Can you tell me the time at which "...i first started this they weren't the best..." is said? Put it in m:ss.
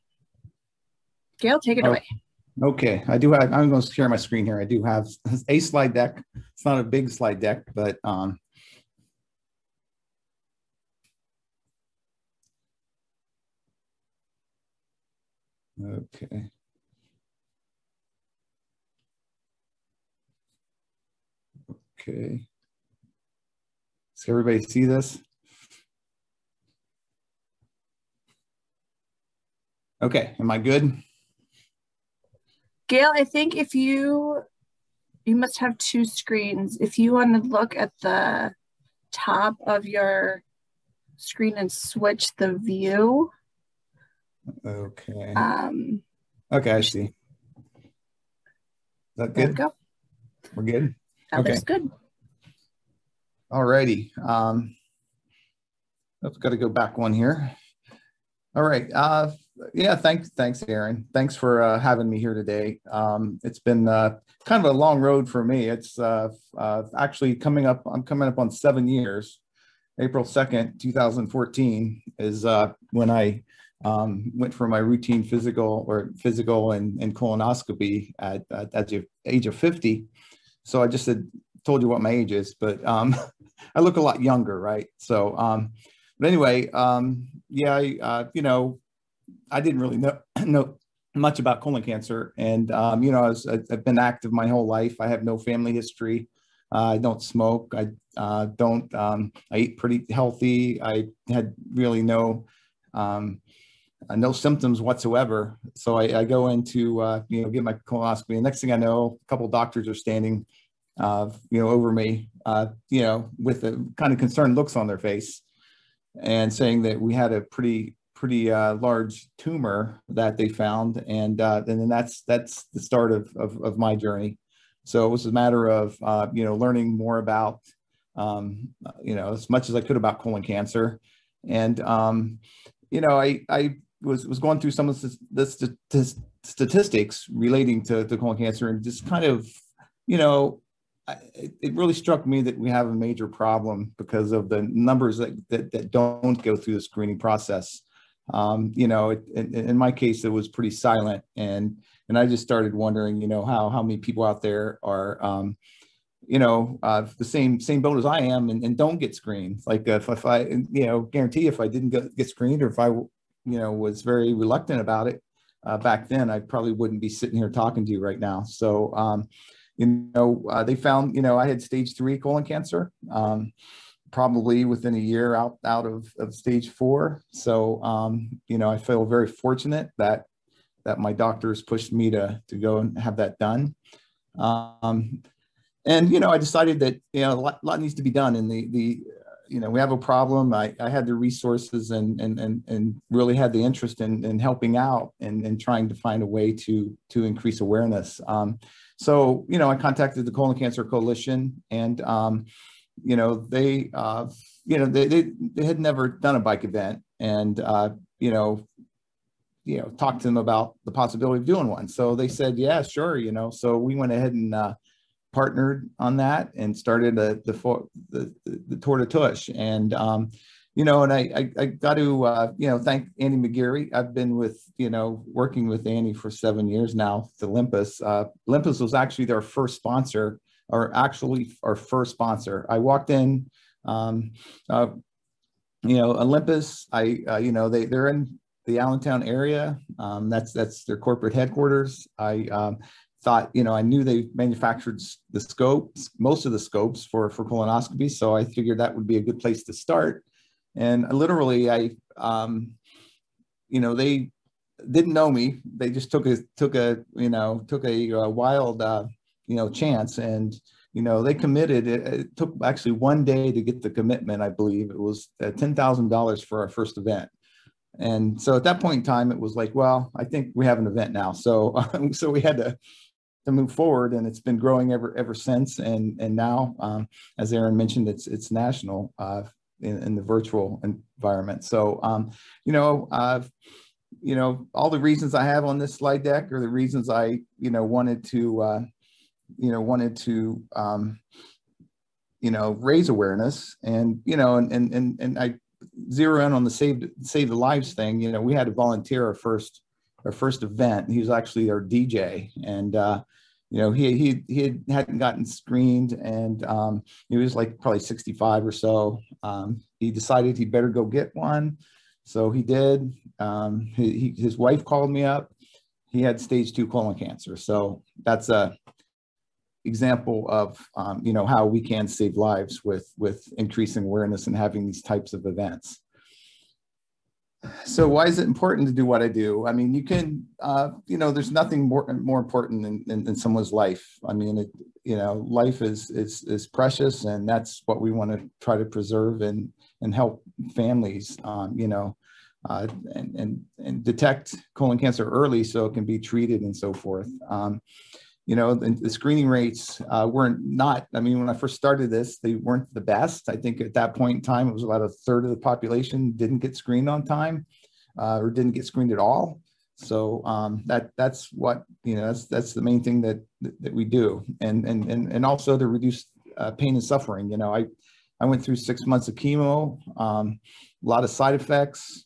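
5:51.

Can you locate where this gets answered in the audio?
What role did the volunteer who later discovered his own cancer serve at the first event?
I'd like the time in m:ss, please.
5:01.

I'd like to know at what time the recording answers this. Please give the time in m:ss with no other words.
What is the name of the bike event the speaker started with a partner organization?
3:38.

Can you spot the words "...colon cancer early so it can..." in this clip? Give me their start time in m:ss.
5:44.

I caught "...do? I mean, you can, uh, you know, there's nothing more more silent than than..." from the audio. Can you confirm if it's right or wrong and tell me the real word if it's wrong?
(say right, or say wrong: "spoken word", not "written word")
wrong: "important", not "silent".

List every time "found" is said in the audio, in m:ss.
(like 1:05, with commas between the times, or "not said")
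2:00, 2:50.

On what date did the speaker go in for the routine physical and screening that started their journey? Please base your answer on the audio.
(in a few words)
April 2, 2014.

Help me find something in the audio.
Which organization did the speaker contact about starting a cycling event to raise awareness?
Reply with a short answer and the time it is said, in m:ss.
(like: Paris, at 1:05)
Colon Cancer Coalition, at 3:20.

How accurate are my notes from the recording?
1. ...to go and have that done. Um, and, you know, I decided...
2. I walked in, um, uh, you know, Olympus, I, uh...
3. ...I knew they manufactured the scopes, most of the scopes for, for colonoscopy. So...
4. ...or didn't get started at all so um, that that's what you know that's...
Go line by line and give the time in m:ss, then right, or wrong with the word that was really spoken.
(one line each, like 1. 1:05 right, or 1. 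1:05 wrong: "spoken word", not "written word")
1. 3:02 right
2. 3:52 right
3. 4:03 right
4. 5:58 wrong: "screened", not "started".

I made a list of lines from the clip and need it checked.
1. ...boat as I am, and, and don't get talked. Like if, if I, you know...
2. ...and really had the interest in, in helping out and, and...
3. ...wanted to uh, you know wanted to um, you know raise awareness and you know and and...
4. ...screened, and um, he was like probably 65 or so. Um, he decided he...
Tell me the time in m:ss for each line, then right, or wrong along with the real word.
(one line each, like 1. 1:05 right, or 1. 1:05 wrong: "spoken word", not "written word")
1. 2:37 wrong: "screened", not "talked"
2. 3:12 right
3. 4:47 right
4. 5:05 right.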